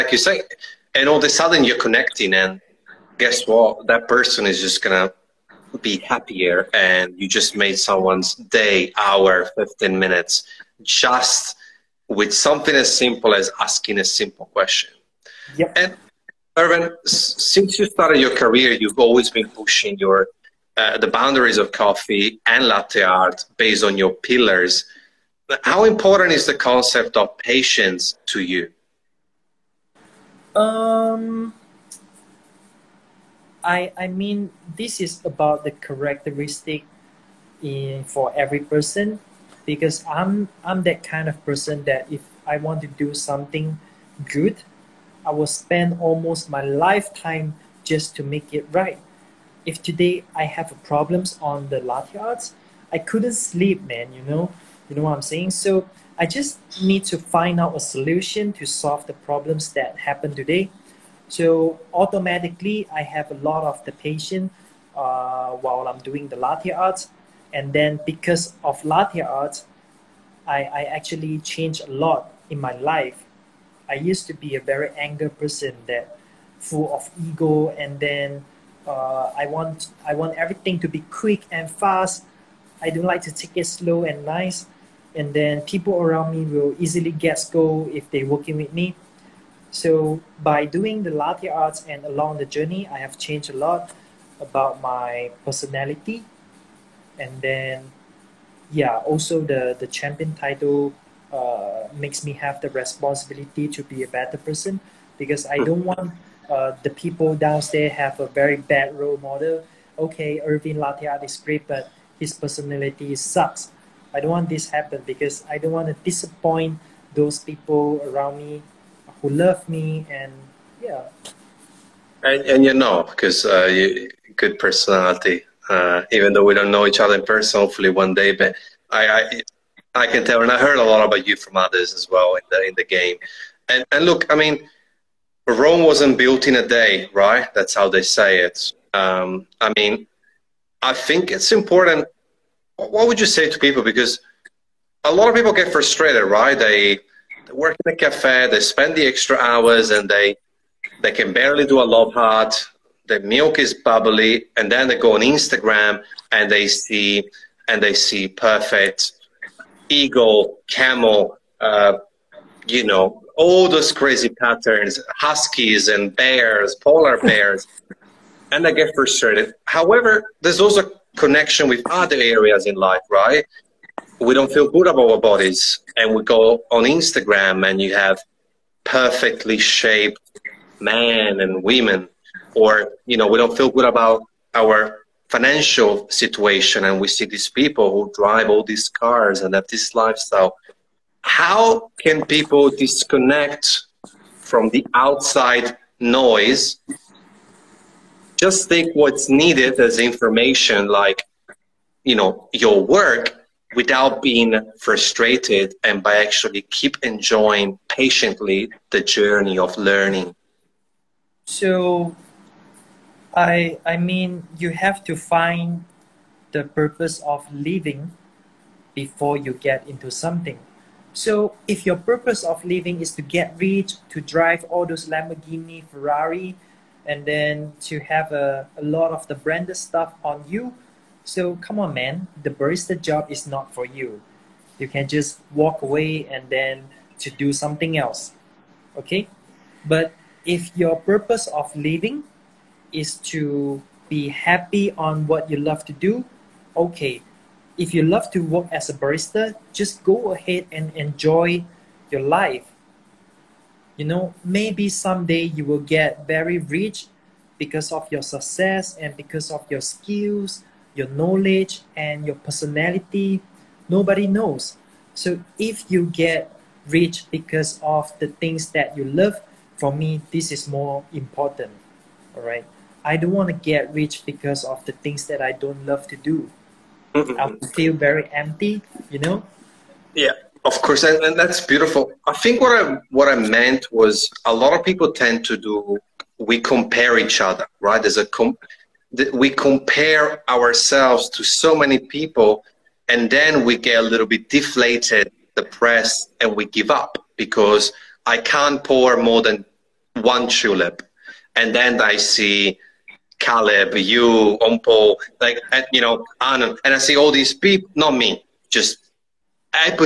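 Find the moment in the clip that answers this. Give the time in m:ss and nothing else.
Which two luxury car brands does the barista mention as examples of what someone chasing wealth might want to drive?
3:45.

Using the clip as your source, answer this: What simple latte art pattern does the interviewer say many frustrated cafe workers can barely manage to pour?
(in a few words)
love heart.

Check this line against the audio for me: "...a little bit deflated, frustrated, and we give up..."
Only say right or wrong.
wrong.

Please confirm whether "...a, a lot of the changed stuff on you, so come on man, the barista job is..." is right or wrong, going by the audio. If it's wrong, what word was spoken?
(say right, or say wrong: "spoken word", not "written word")
wrong: "branded", not "changed".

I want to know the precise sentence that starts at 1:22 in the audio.
I don't like to take it slow and nice.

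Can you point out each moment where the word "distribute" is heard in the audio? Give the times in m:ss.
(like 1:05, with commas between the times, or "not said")
not said.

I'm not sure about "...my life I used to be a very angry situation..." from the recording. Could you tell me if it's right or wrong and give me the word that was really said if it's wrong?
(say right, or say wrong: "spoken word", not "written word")
wrong: "person", not "situation".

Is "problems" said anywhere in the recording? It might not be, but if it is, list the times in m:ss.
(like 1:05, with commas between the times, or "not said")
0:50, 0:59.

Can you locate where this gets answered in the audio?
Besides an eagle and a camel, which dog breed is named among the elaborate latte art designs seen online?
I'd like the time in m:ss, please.
2:45.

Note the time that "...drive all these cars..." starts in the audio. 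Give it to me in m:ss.
3:08.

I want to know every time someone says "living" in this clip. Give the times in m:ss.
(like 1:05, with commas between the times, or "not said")
3:37, 3:42, 4:01.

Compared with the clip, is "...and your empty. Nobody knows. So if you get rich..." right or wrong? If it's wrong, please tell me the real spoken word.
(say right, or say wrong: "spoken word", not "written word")
wrong: "personality", not "empty".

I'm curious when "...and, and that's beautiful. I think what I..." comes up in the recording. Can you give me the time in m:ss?
4:41.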